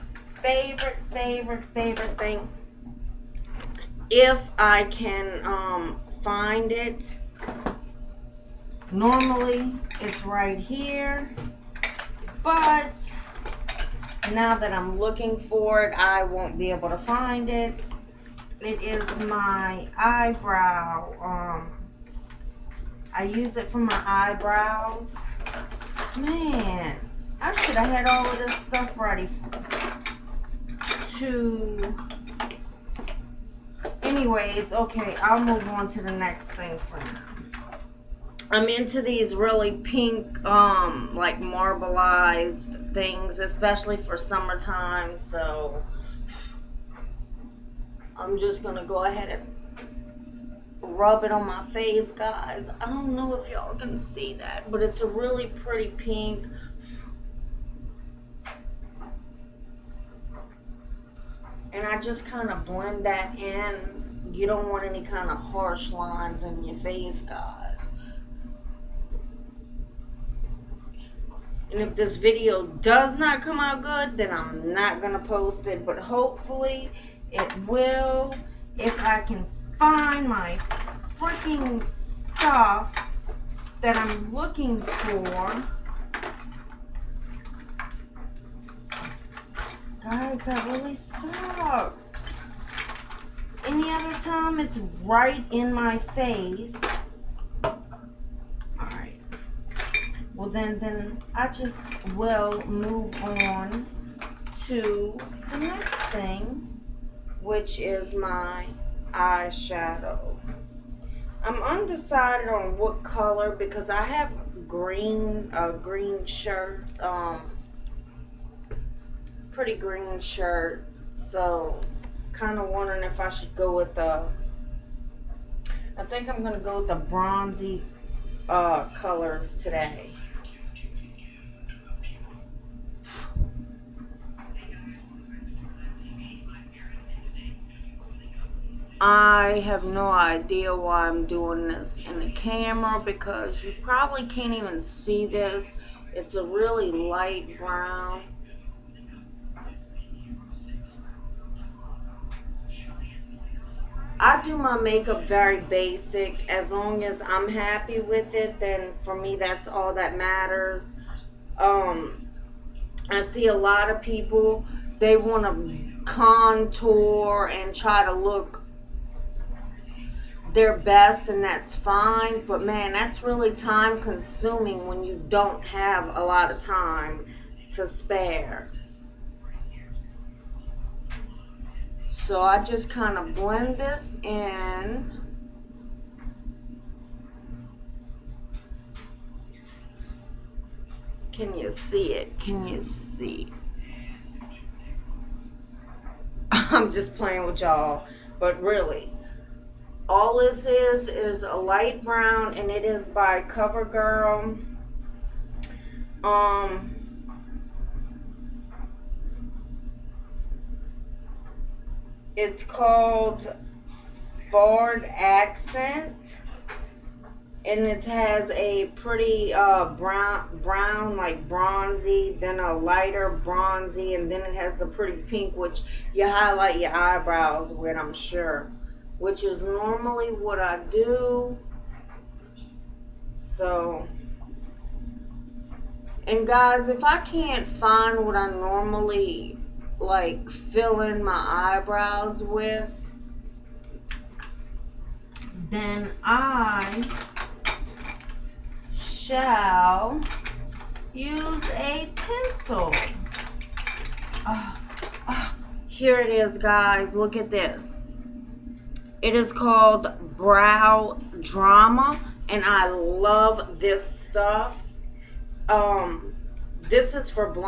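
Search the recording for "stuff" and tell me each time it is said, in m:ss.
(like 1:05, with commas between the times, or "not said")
0:28, 1:22, 4:24.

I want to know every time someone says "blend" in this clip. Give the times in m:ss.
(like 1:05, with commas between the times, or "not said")
1:02, 3:03.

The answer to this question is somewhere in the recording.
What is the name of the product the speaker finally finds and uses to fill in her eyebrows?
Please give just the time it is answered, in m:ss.
4:20.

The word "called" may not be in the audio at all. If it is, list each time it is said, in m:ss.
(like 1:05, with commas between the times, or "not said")
3:32, 4:19.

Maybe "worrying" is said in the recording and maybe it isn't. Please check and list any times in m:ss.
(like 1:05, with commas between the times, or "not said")
not said.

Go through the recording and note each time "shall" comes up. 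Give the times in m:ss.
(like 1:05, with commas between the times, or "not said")
4:08.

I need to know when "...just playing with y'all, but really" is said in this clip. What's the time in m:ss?
3:16.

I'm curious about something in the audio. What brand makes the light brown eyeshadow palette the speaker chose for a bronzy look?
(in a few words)
CoverGirl.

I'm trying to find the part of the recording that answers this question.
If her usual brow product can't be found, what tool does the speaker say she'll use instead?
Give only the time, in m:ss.
4:12.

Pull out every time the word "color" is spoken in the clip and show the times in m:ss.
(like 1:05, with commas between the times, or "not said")
1:53, 2:08.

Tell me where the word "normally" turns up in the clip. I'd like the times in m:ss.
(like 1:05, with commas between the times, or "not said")
0:08, 3:49, 3:58.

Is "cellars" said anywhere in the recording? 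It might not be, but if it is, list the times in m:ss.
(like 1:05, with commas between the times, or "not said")
not said.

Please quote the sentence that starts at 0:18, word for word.
It is my eyebrow um, I use it for my eyebrows.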